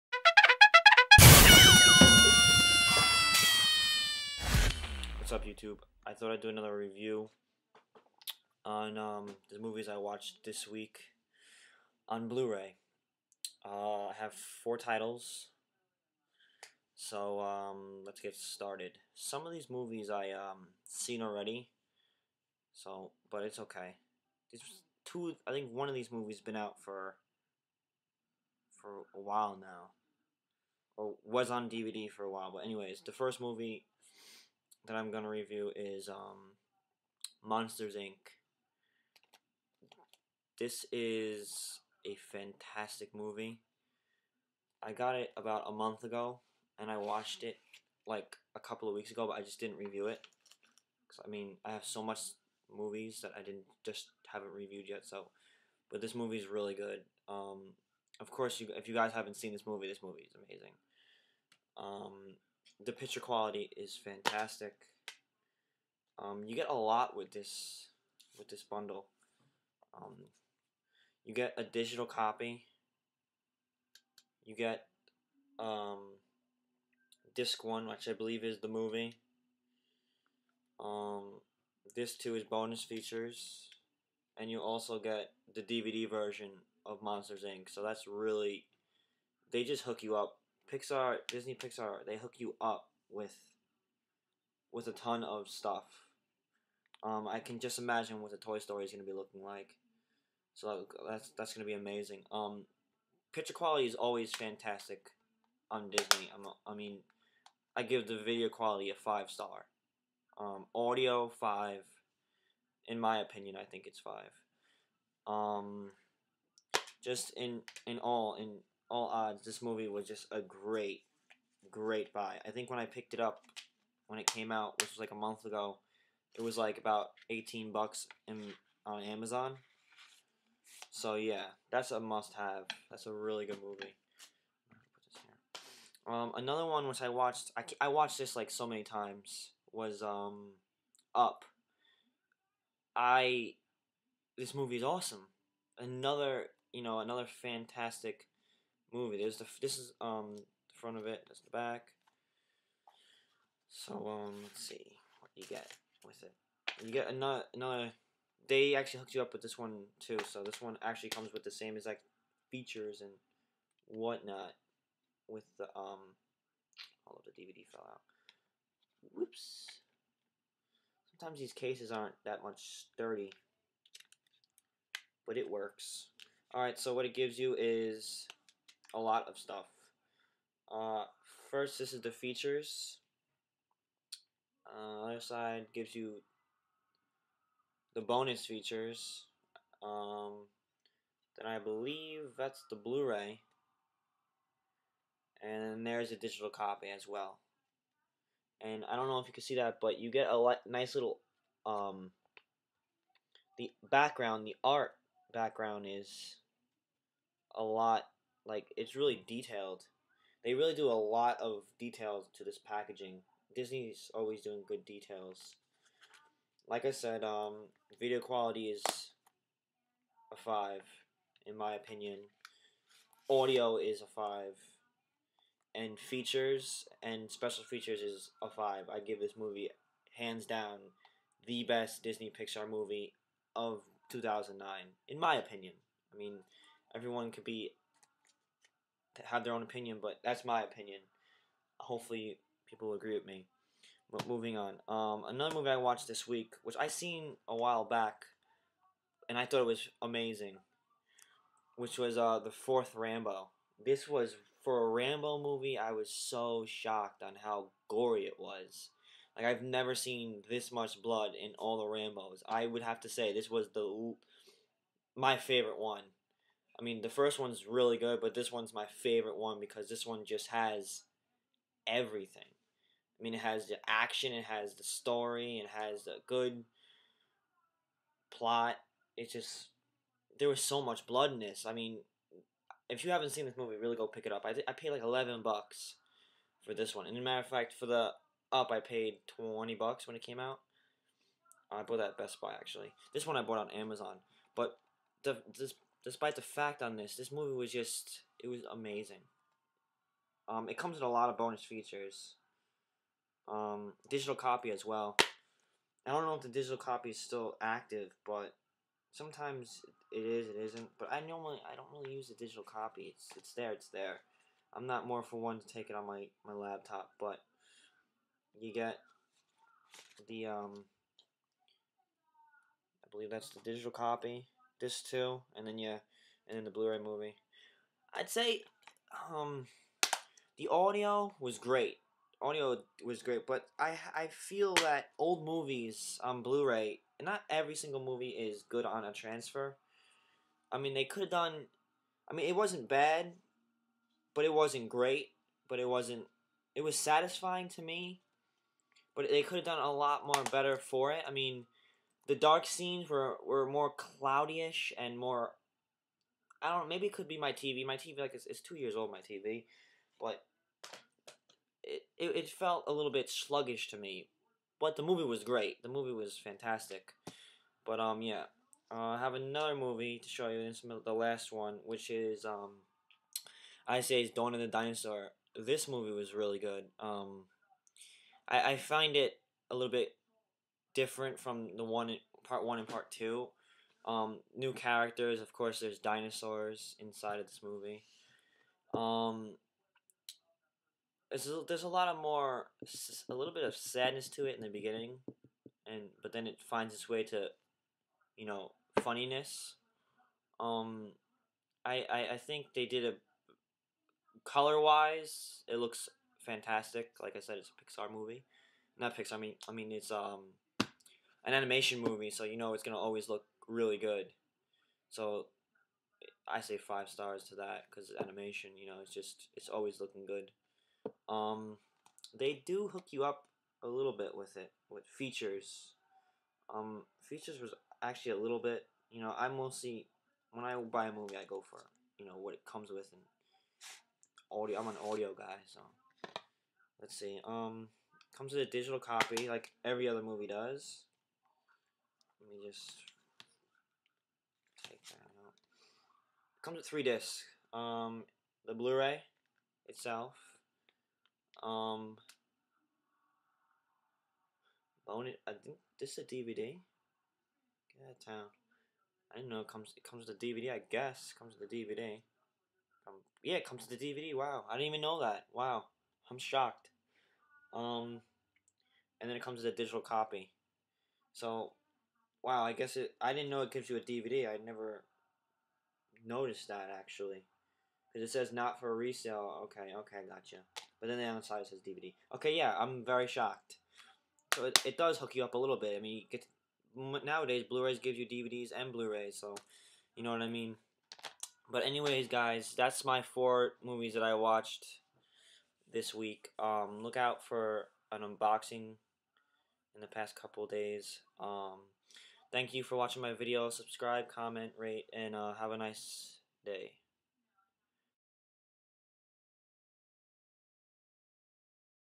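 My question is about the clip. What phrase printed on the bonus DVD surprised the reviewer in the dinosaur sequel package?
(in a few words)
not for resale.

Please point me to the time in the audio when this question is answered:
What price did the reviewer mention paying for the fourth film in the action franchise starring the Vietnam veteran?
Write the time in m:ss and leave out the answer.
4:45.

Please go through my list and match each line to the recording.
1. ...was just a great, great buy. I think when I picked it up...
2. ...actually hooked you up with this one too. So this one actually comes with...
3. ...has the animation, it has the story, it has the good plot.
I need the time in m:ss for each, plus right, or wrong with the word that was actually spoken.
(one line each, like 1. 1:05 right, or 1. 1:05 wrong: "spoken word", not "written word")
1. 1:59 right
2. 2:38 right
3. 4:33 wrong: "action", not "animation".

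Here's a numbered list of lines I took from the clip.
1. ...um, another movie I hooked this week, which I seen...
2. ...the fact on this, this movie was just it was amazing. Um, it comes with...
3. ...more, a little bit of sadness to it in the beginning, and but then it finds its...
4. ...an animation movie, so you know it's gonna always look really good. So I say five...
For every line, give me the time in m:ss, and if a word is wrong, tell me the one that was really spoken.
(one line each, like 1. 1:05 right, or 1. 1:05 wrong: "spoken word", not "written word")
1. 4:04 wrong: "watched", not "hooked"
2. 4:56 right
3. 6:32 right
4. 6:51 right.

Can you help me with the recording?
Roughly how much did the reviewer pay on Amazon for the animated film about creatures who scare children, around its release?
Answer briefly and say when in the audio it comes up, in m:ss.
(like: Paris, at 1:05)
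$18, at 2:07.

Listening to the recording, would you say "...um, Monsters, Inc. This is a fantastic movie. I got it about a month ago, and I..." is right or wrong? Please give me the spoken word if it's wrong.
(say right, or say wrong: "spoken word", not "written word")
right.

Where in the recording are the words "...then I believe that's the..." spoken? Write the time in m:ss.
3:11.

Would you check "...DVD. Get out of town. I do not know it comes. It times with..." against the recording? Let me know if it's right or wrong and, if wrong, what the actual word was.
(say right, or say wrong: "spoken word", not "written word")
wrong: "comes", not "times".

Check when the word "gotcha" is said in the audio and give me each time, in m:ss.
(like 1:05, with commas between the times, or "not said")
8:00.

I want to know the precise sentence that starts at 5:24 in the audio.
This too, and then yeah, and then the Blu-ray movie.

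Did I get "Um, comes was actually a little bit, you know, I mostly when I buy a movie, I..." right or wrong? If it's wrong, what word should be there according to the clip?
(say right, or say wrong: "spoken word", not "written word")
wrong: "features", not "comes".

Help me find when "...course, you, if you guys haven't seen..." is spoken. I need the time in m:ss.
0:58.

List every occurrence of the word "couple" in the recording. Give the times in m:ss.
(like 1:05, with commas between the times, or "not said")
0:48, 8:20.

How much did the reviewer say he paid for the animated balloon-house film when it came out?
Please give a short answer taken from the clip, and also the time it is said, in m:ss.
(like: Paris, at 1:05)
$20, at 4:49.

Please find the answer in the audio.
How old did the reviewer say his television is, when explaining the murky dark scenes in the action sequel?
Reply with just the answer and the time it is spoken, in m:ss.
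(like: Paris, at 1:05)
2 years, at 5:58.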